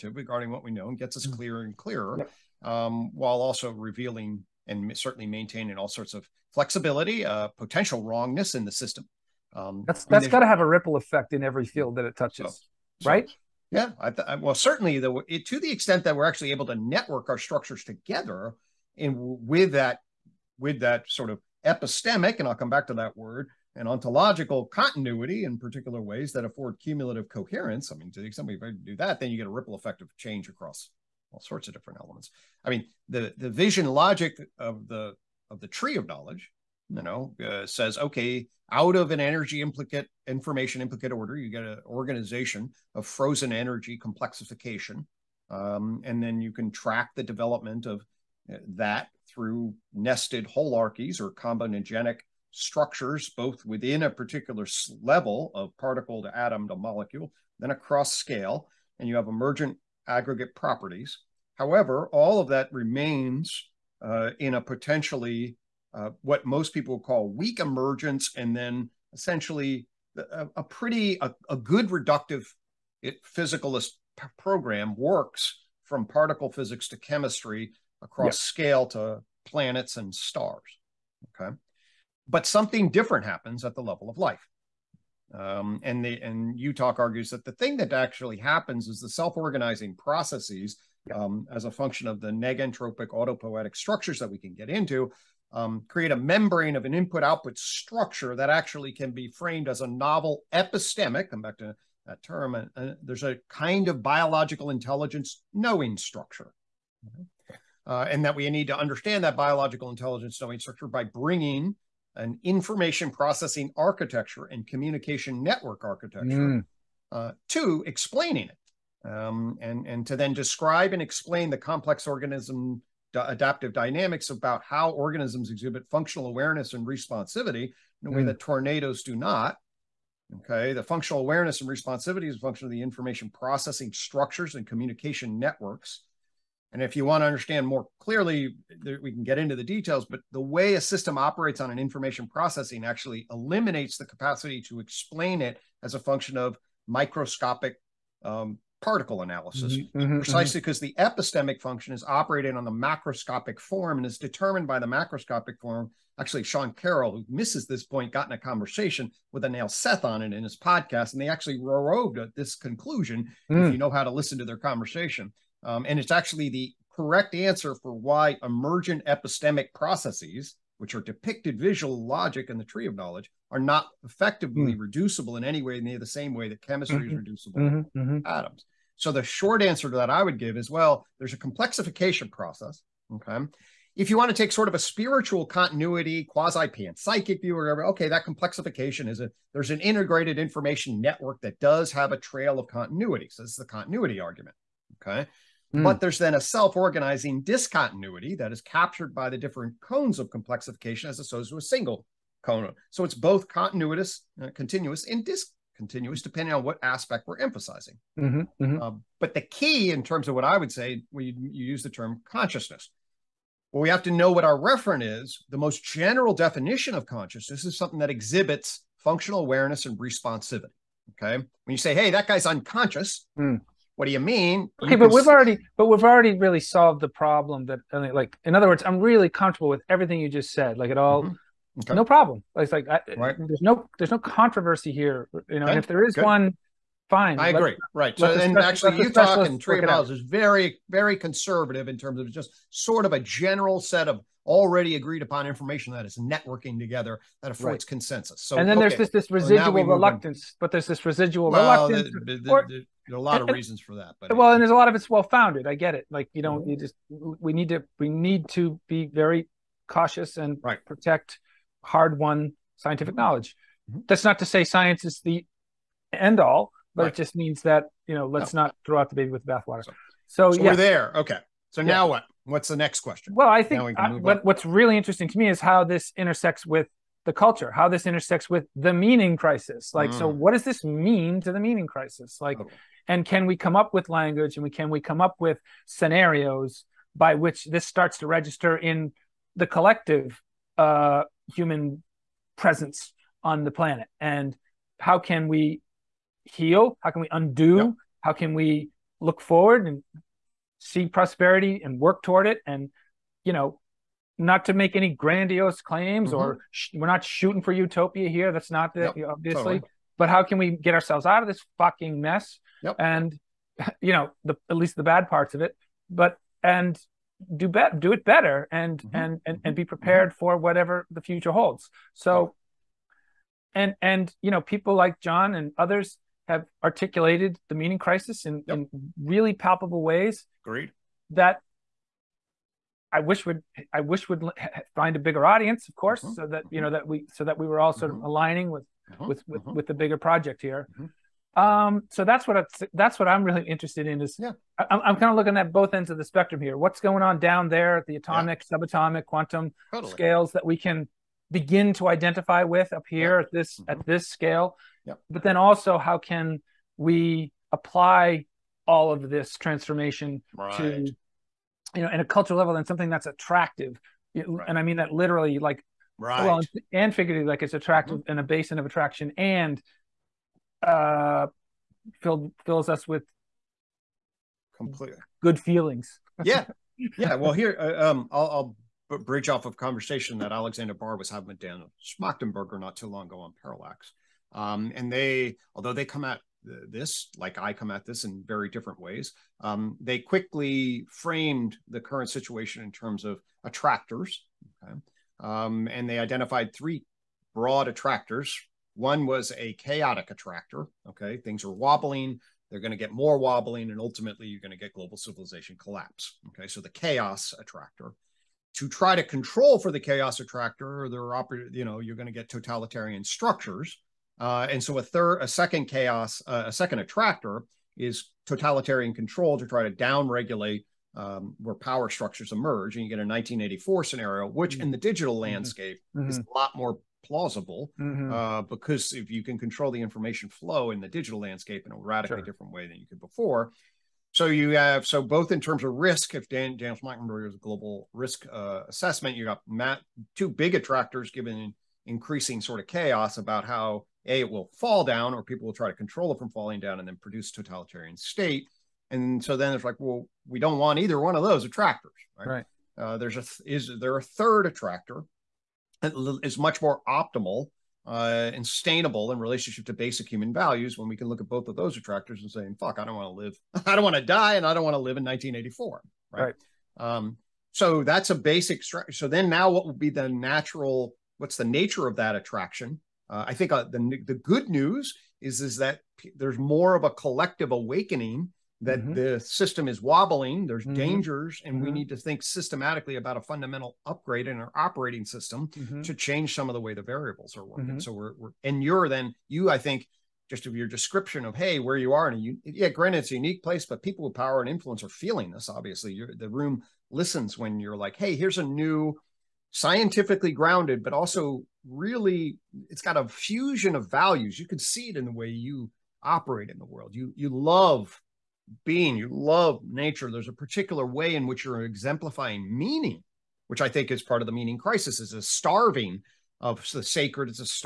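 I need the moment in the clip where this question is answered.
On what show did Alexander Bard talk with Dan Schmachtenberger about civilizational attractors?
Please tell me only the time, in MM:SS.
06:23.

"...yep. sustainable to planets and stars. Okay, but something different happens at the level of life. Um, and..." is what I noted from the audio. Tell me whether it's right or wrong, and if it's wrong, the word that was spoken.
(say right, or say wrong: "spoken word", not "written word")
wrong: "scale", not "sustainable".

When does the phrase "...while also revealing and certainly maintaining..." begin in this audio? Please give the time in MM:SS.
00:03.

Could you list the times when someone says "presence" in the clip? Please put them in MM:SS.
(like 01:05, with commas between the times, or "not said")
04:52.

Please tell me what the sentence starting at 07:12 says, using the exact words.
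different way than you could before.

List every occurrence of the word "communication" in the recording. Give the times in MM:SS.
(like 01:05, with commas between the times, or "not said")
01:54, 02:14.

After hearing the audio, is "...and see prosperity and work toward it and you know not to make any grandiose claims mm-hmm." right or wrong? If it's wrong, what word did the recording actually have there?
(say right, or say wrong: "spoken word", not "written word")
right.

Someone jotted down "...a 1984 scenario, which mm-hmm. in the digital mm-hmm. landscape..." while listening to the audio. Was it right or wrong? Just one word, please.
right.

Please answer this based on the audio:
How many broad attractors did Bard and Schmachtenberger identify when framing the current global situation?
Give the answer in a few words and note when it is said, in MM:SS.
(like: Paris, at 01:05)
3, at 06:36.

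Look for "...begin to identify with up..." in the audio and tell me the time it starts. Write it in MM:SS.
05:51.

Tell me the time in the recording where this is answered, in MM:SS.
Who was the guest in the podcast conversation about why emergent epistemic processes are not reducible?
02:39.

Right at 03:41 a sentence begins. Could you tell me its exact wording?
Okay, when you say, "Hey, that guy's unconscious," mm.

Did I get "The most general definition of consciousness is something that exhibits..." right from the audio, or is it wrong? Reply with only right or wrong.
right.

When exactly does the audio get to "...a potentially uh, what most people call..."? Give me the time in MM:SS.
01:04.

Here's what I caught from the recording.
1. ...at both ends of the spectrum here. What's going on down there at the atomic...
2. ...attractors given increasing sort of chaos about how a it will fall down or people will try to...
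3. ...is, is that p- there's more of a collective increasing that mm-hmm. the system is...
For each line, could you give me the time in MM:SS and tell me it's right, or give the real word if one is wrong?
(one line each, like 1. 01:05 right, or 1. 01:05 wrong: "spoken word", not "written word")
1. 05:45 right
2. 07:20 right
3. 07:55 wrong: "awakening", not "increasing".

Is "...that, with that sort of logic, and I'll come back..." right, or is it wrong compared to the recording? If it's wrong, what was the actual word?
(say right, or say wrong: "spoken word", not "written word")
wrong: "epistemic", not "logic".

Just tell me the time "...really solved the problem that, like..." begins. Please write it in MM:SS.
03:46.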